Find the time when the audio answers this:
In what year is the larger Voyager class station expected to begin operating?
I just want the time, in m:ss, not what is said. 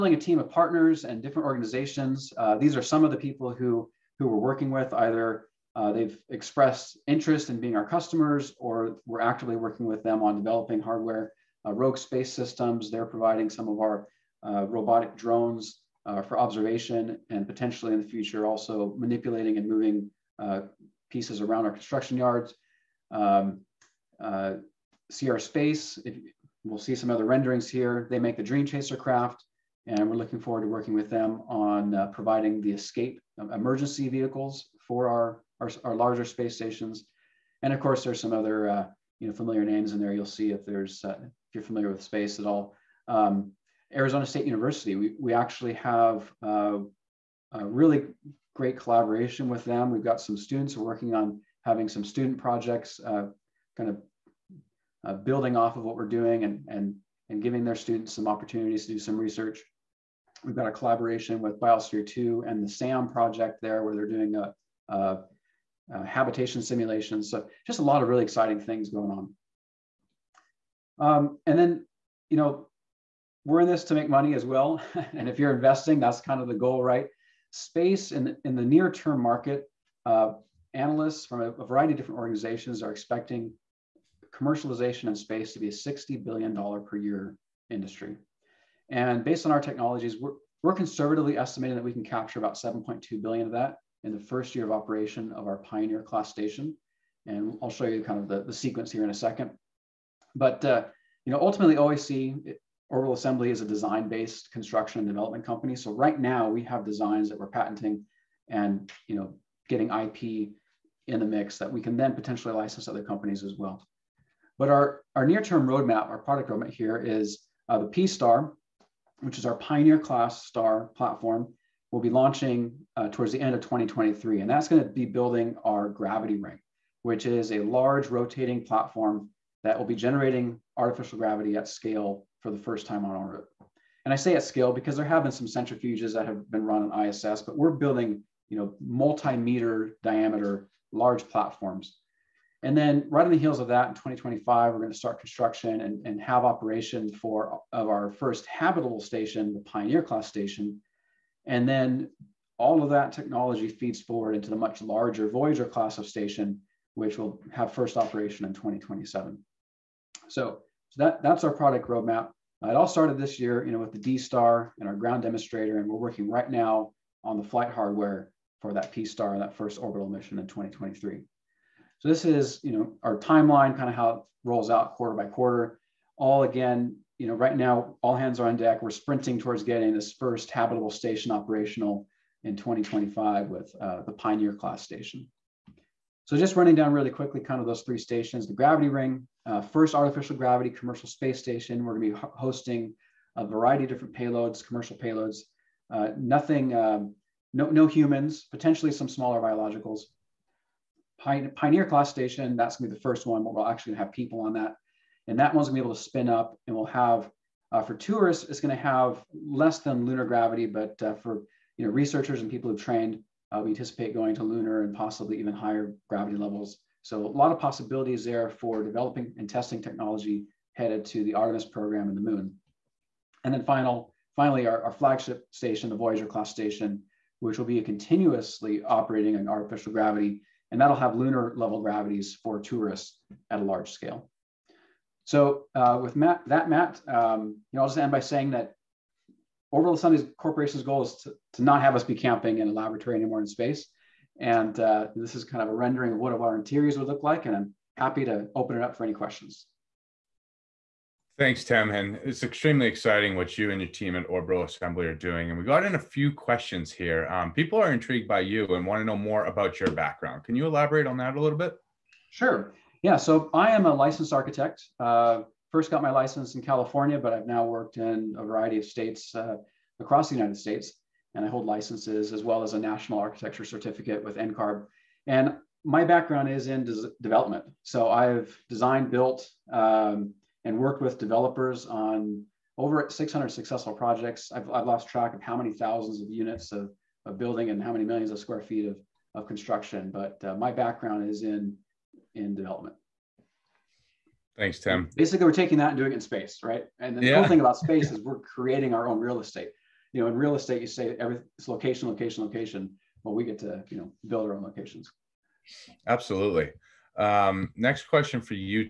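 2:38.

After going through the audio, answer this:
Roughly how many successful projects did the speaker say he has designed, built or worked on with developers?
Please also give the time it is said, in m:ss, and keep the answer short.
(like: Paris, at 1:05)
600, at 4:43.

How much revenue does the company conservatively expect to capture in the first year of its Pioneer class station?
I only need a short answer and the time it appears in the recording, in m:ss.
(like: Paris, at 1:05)
7.2 billion, at 1:32.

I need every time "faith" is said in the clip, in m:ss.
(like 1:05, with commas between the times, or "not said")
not said.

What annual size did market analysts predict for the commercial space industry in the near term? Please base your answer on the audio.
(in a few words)
$60 billion.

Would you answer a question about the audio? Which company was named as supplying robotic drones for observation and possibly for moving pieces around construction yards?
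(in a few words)
Rogue Space Systems.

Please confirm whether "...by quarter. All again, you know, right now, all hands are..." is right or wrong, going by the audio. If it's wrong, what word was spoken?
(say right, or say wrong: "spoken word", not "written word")
right.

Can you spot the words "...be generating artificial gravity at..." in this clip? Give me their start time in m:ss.
2:09.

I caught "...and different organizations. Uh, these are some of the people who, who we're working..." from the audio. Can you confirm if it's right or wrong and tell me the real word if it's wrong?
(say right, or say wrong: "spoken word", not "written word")
right.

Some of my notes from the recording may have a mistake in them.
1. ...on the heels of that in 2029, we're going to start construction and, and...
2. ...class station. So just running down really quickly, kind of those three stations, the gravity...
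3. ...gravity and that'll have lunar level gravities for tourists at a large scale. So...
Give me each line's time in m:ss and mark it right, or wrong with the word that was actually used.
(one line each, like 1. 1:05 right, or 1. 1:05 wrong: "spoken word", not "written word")
1. 2:23 wrong: "2025", not "2029"
2. 3:04 right
3. 3:49 right.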